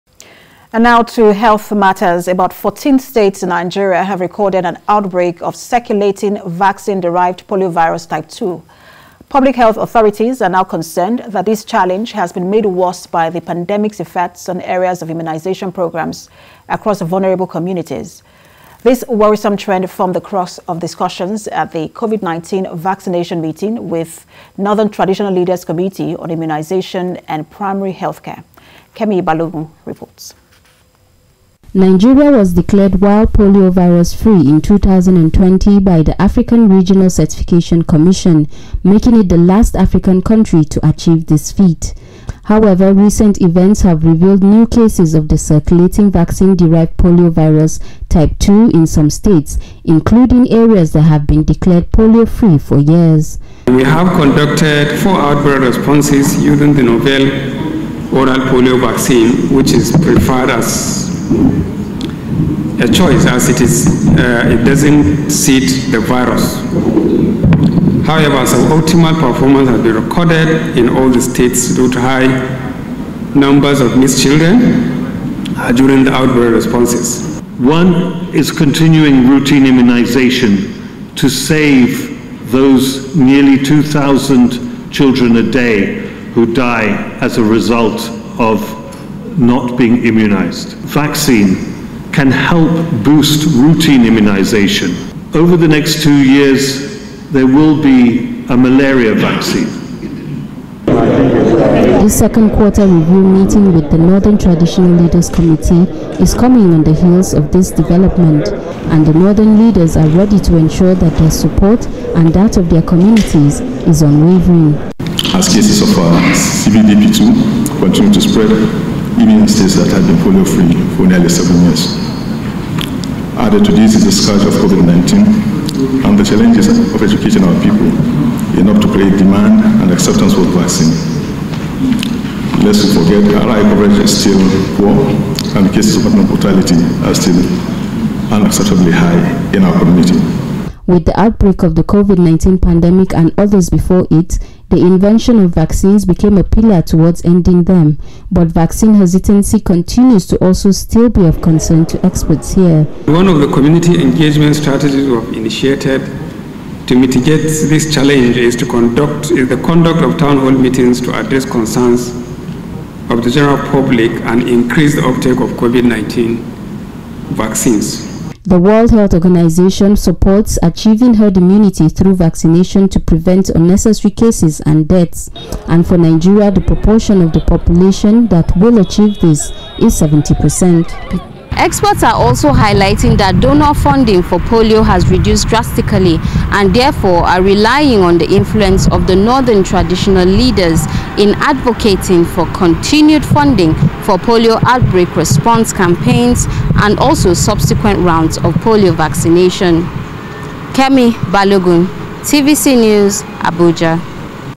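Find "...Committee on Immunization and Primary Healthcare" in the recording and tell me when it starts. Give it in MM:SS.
00:25.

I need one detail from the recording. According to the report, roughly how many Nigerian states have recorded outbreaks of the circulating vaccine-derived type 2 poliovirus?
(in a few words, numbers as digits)
14.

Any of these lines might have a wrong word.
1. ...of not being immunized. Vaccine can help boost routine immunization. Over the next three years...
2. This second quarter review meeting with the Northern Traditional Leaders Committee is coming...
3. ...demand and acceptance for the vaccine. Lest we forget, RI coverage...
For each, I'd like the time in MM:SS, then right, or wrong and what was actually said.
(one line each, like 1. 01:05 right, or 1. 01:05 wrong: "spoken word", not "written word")
1. 01:28 wrong: "two", not "three"
2. 01:42 right
3. 02:09 right.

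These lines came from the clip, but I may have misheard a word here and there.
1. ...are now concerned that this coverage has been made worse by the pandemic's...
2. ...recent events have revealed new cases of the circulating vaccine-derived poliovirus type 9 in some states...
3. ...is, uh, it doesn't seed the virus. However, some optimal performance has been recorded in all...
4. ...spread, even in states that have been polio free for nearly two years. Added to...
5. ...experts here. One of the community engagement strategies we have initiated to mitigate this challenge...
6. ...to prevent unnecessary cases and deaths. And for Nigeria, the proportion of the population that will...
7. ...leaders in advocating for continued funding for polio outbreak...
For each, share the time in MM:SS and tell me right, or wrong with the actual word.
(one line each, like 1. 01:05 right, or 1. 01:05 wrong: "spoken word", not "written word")
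1. 00:10 wrong: "challenge", not "coverage"
2. 00:42 wrong: "2", not "9"
3. 01:03 right
4. 01:58 wrong: "seven", not "two"
5. 02:32 right
6. 02:52 right
7. 03:10 right.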